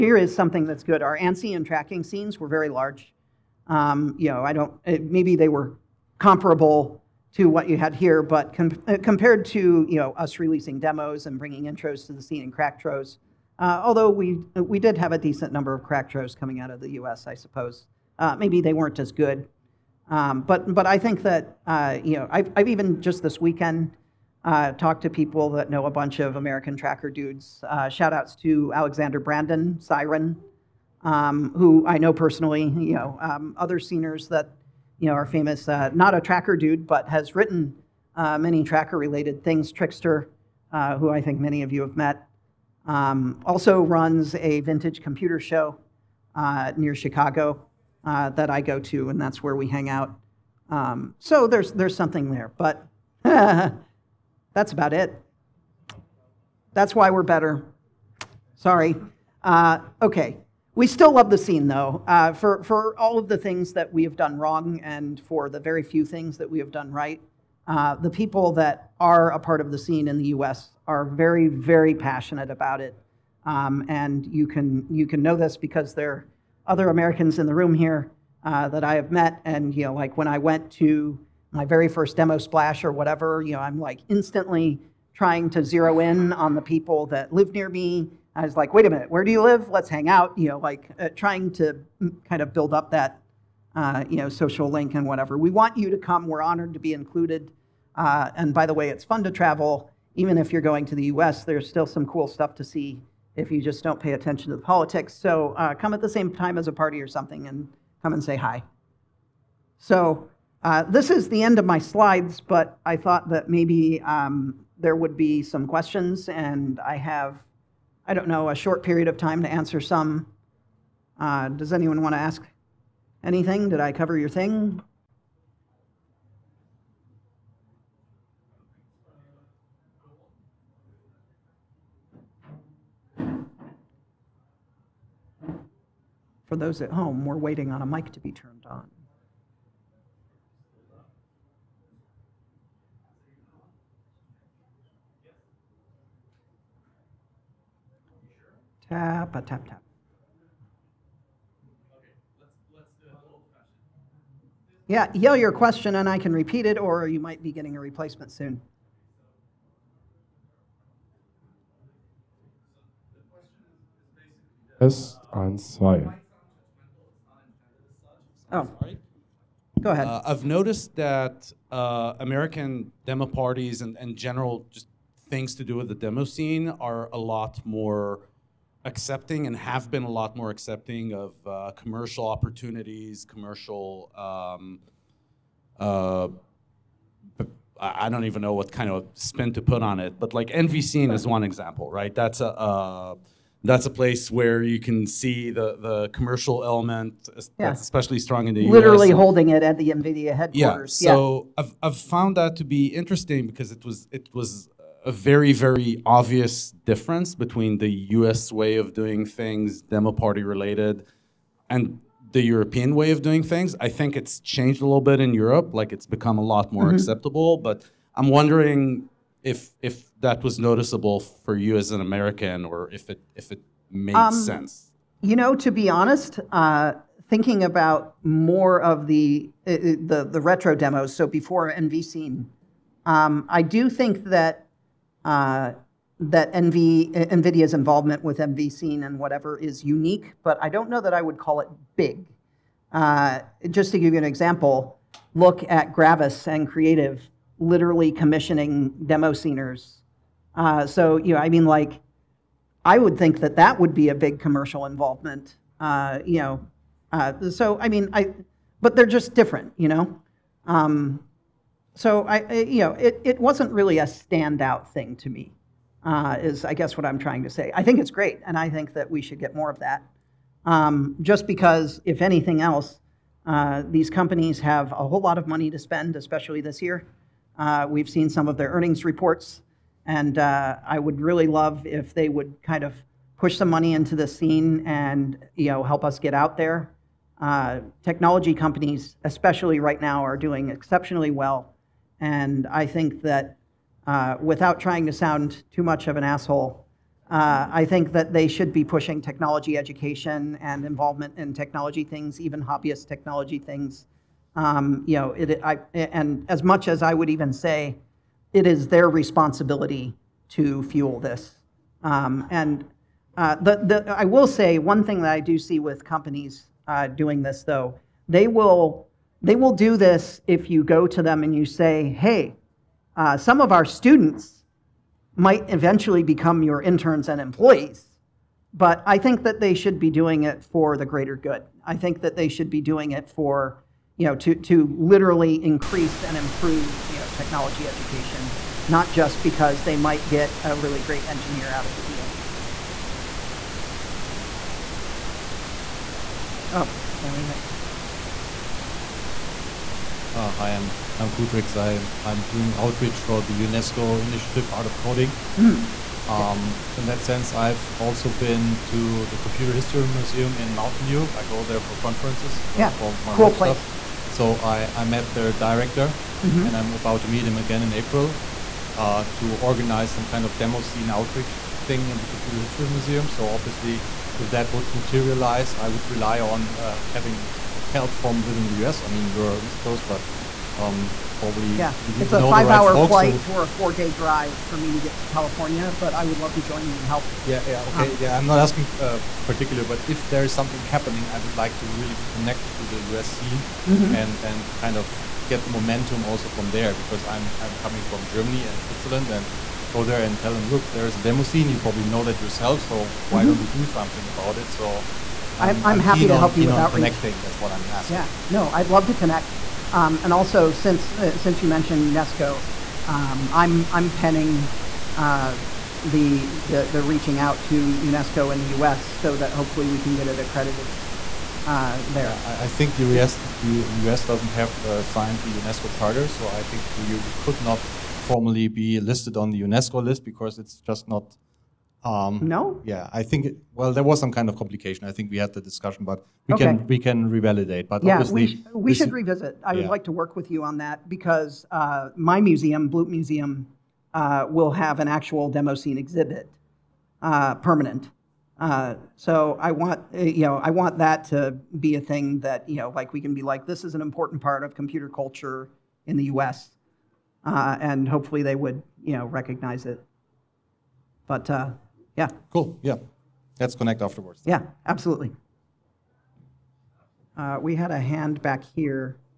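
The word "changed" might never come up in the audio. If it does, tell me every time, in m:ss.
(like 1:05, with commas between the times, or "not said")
3:34.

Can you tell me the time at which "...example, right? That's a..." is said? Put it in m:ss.
3:11.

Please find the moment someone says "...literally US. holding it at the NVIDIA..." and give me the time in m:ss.
3:18.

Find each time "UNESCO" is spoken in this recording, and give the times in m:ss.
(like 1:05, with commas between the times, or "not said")
5:53, 6:52, 6:57, 7:05, 7:09.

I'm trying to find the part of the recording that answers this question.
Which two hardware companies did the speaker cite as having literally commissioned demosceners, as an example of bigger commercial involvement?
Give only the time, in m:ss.
4:05.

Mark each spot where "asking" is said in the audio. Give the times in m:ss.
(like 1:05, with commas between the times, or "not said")
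6:28, 6:47.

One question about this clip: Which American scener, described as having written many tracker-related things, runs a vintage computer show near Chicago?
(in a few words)
Trixter.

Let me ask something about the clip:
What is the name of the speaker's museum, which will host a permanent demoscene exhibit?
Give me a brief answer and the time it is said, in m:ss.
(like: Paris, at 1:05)
Bloop Museum, at 7:22.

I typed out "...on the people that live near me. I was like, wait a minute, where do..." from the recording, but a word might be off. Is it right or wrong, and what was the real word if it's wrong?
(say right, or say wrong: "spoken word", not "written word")
right.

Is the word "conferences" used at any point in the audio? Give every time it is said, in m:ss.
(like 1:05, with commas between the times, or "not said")
6:01.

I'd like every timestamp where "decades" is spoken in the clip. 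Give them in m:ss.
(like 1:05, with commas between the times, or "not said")
not said.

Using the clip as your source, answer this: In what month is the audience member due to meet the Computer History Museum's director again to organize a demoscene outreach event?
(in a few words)
April.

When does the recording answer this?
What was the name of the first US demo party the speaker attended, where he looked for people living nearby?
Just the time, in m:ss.
1:22.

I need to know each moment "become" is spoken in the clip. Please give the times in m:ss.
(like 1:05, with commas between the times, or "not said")
3:36, 5:26.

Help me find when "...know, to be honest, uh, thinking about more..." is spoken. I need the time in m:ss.
3:45.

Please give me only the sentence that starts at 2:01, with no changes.
Uh, does anyone want to ask anything?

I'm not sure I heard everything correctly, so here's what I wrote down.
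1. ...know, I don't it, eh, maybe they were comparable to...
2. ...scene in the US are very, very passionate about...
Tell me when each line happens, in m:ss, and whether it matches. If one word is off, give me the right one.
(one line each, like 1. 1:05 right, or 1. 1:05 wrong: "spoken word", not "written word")
1. 0:04 right
2. 1:09 right.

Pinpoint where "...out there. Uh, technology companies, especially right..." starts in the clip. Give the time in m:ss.
4:46.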